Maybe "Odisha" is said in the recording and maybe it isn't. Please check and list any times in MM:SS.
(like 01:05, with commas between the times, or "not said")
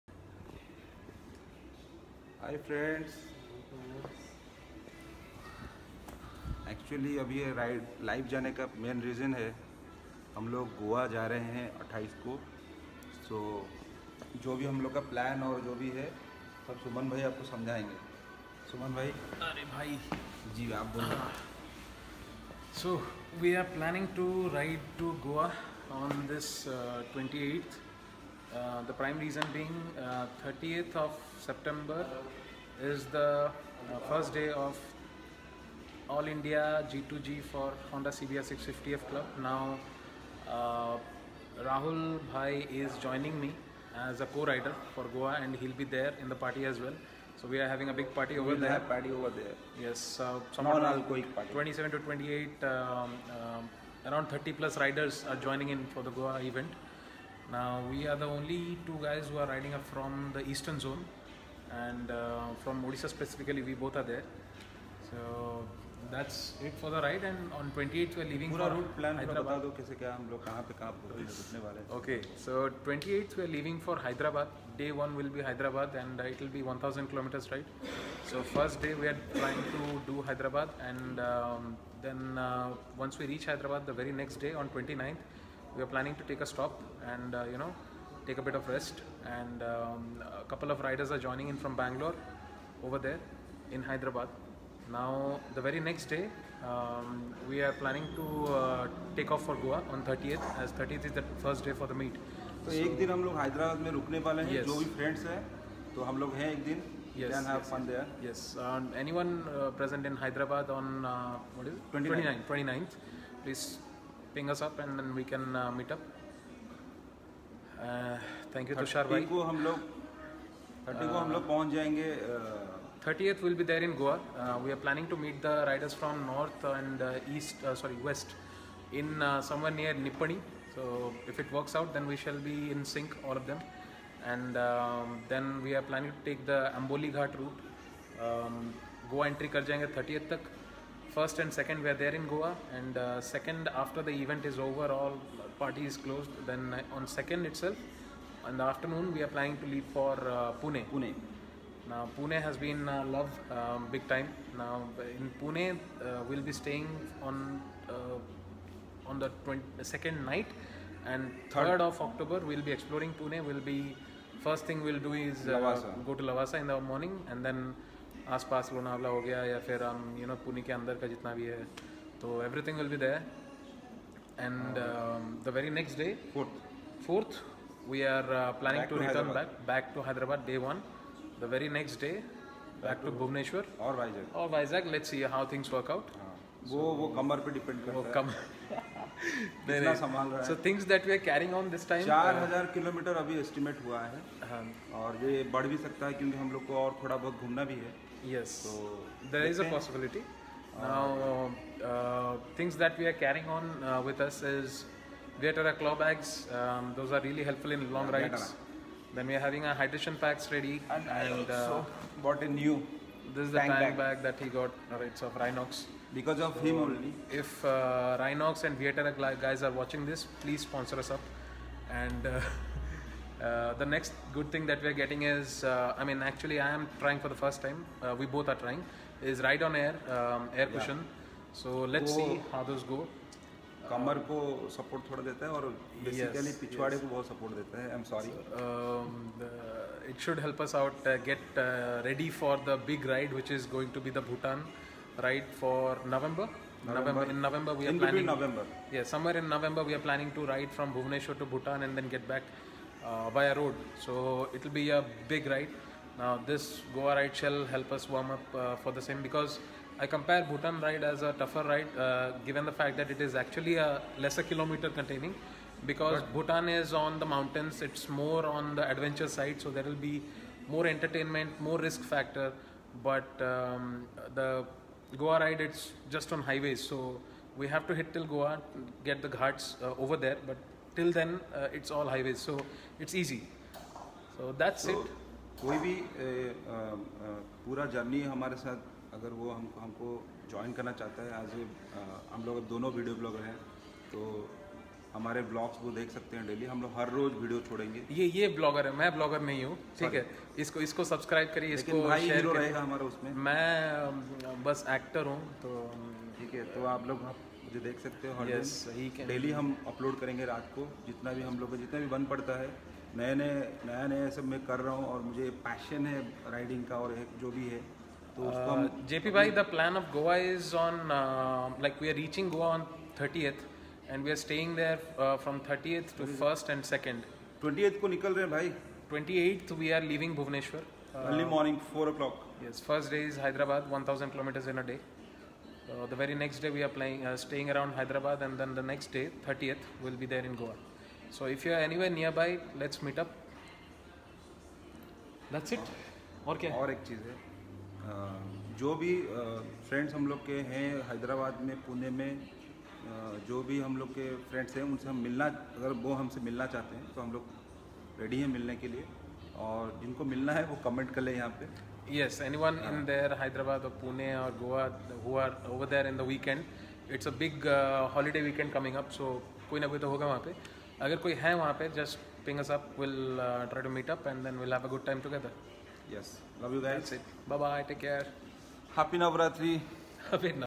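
01:02.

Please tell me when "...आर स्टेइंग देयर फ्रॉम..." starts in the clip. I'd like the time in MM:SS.
05:24.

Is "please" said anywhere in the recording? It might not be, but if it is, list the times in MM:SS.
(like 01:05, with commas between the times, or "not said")
01:53, 03:40.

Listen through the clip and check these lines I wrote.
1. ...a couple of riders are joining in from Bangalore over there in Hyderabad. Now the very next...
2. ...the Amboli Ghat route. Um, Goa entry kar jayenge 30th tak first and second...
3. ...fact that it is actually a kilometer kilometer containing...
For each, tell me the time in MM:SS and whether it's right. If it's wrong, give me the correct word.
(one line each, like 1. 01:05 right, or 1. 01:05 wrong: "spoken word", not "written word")
1. 01:30 right
2. 02:16 right
3. 04:22 wrong: "lesser", not "kilometer".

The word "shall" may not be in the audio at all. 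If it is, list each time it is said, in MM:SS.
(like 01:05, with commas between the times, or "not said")
02:12, 04:17.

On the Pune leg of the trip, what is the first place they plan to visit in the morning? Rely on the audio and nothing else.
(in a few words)
Lavasa.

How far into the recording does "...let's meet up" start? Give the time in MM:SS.
05:42.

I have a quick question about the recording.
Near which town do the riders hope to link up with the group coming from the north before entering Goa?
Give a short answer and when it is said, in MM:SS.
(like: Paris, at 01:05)
Nippani, at 02:09.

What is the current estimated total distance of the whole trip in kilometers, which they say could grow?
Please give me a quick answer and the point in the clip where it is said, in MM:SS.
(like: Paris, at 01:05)
4000 kilometers, at 03:12.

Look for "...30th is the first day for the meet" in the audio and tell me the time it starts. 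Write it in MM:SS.
01:40.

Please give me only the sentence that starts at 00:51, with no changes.
27 to 28, um, um, around 30 plus riders are joining in for the Goa event.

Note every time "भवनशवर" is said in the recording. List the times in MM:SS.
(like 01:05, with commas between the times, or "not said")
03:03, 05:30.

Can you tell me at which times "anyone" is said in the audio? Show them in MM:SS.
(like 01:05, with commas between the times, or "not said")
01:49, 06:02.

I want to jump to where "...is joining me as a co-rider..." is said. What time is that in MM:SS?
00:42.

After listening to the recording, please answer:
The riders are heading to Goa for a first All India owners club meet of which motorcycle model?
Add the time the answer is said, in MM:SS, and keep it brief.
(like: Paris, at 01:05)
Honda CBR 650F, at 00:37.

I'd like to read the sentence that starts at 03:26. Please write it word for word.
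Um, those are really helpful in long yeah, rides.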